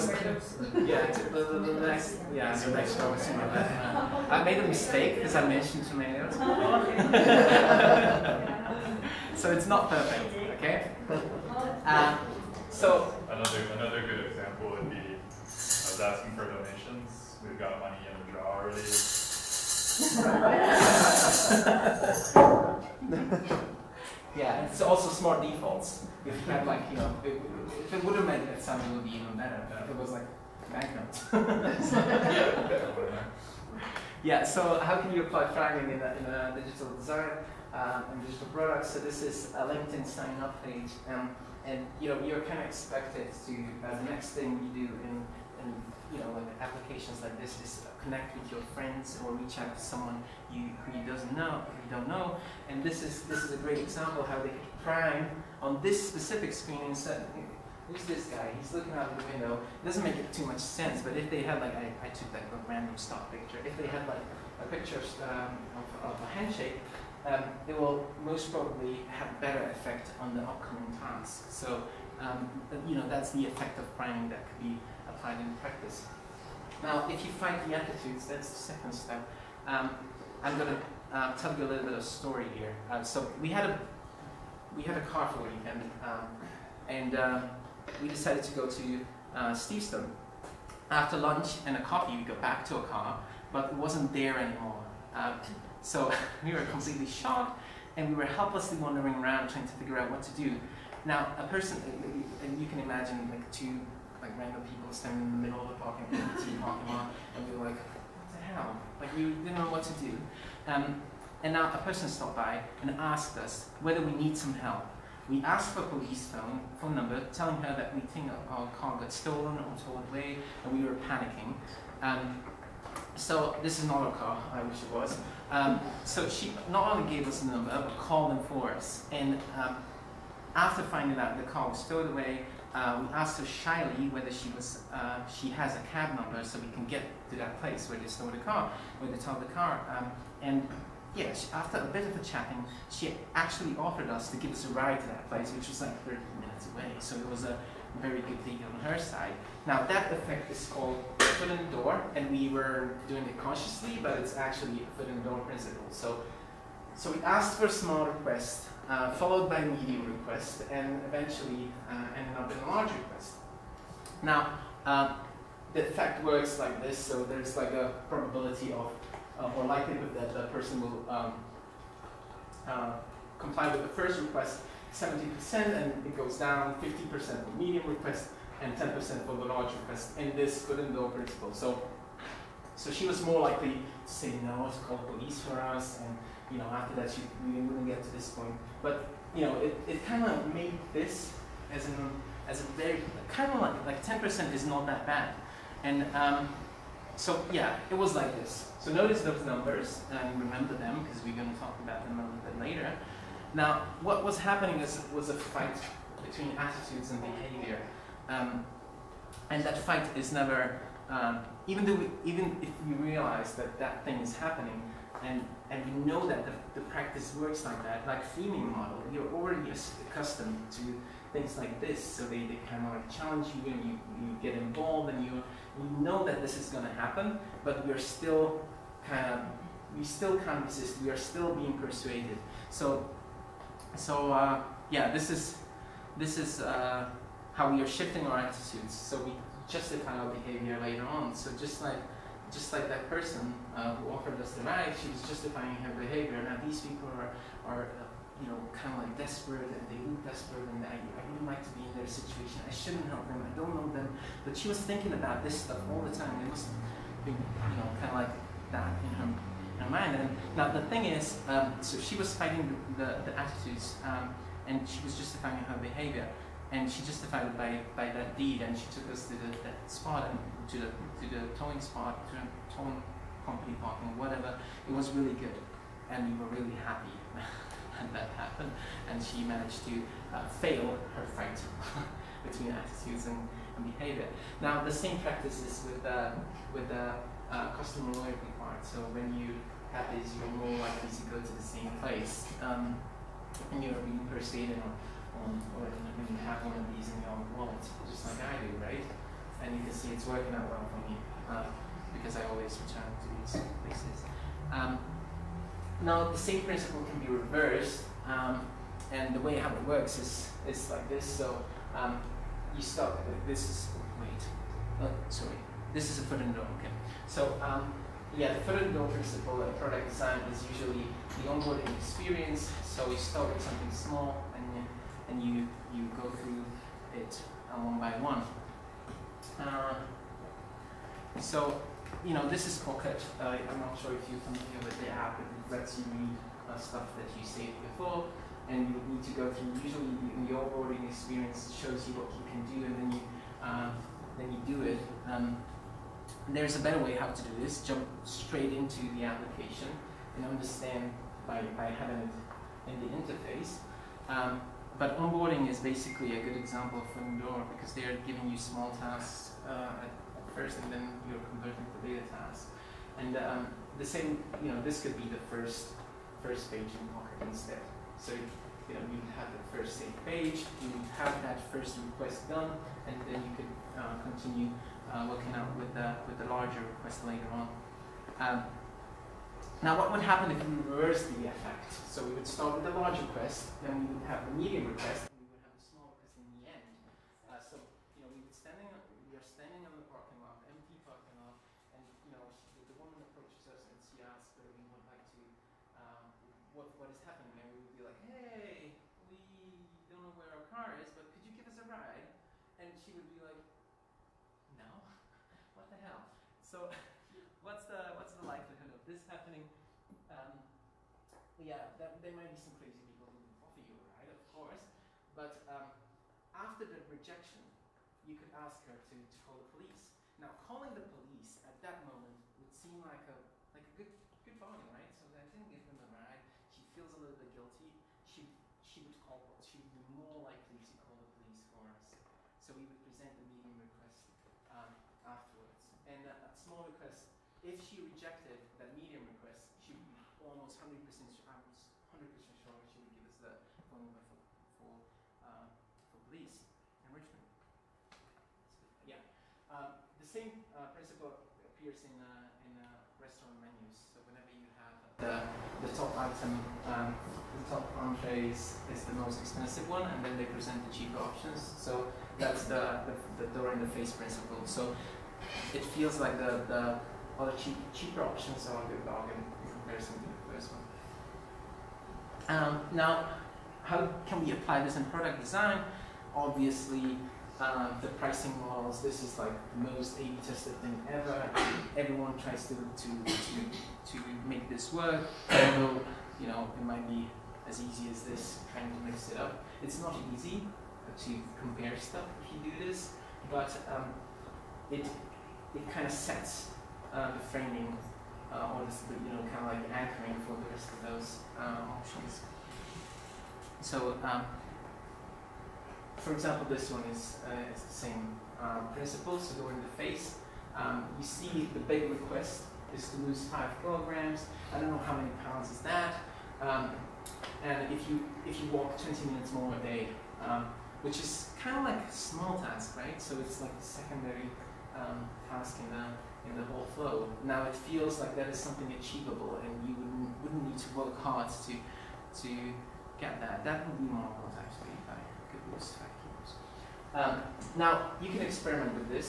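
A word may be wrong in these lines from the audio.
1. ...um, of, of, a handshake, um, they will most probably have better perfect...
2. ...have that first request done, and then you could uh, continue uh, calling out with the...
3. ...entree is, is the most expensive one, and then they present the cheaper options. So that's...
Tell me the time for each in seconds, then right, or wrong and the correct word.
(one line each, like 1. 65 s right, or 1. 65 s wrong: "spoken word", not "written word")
1. 65 s wrong: "effect", not "perfect"
2. 371 s wrong: "working", not "calling"
3. 458 s right.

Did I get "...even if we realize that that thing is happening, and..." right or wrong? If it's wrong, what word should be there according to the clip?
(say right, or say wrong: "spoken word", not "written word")
right.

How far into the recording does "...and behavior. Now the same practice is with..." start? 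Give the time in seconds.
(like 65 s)
283 s.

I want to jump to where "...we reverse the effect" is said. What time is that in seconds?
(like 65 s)
380 s.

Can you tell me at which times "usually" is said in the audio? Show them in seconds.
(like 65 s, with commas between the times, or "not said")
320 s, 339 s.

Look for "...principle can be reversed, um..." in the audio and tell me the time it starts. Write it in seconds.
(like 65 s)
306 s.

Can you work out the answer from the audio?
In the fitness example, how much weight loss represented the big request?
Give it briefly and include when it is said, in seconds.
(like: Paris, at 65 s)
5 kilograms, at 513 s.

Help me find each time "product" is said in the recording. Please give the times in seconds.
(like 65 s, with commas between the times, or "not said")
38 s, 319 s, 475 s.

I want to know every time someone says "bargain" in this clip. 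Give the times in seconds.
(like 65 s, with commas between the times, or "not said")
424 s, 469 s.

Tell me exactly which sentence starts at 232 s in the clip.
So, so uh, yeah, this is, this is uh, how we are shifting our attitudes, so we justify our behavior later on.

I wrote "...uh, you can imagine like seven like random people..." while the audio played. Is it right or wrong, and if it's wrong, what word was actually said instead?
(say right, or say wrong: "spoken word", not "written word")
wrong: "two", not "seven".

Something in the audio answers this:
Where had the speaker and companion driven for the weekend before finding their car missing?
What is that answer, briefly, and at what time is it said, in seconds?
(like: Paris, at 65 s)
Steveston, at 89 s.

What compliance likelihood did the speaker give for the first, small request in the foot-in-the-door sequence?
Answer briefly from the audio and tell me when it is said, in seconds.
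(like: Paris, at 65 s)
70%, at 174 s.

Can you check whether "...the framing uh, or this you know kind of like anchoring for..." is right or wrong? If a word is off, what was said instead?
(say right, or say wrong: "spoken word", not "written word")
right.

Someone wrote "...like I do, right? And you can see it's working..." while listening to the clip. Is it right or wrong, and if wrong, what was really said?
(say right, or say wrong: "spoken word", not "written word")
right.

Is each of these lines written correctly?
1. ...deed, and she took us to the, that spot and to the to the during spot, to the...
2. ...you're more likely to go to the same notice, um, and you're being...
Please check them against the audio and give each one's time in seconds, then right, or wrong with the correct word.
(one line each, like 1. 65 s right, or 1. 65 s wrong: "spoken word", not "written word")
1. 268 s wrong: "towing", not "during"
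2. 290 s wrong: "place", not "notice".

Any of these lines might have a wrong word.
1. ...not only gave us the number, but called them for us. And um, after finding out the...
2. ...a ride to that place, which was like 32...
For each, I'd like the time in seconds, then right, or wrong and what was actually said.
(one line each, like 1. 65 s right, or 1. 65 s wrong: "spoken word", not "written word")
1. 126 s right
2. 144 s wrong: "30", not "32".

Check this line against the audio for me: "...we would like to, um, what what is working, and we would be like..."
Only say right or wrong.
wrong.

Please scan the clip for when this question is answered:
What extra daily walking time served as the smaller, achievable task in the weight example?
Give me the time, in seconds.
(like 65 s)
519 s.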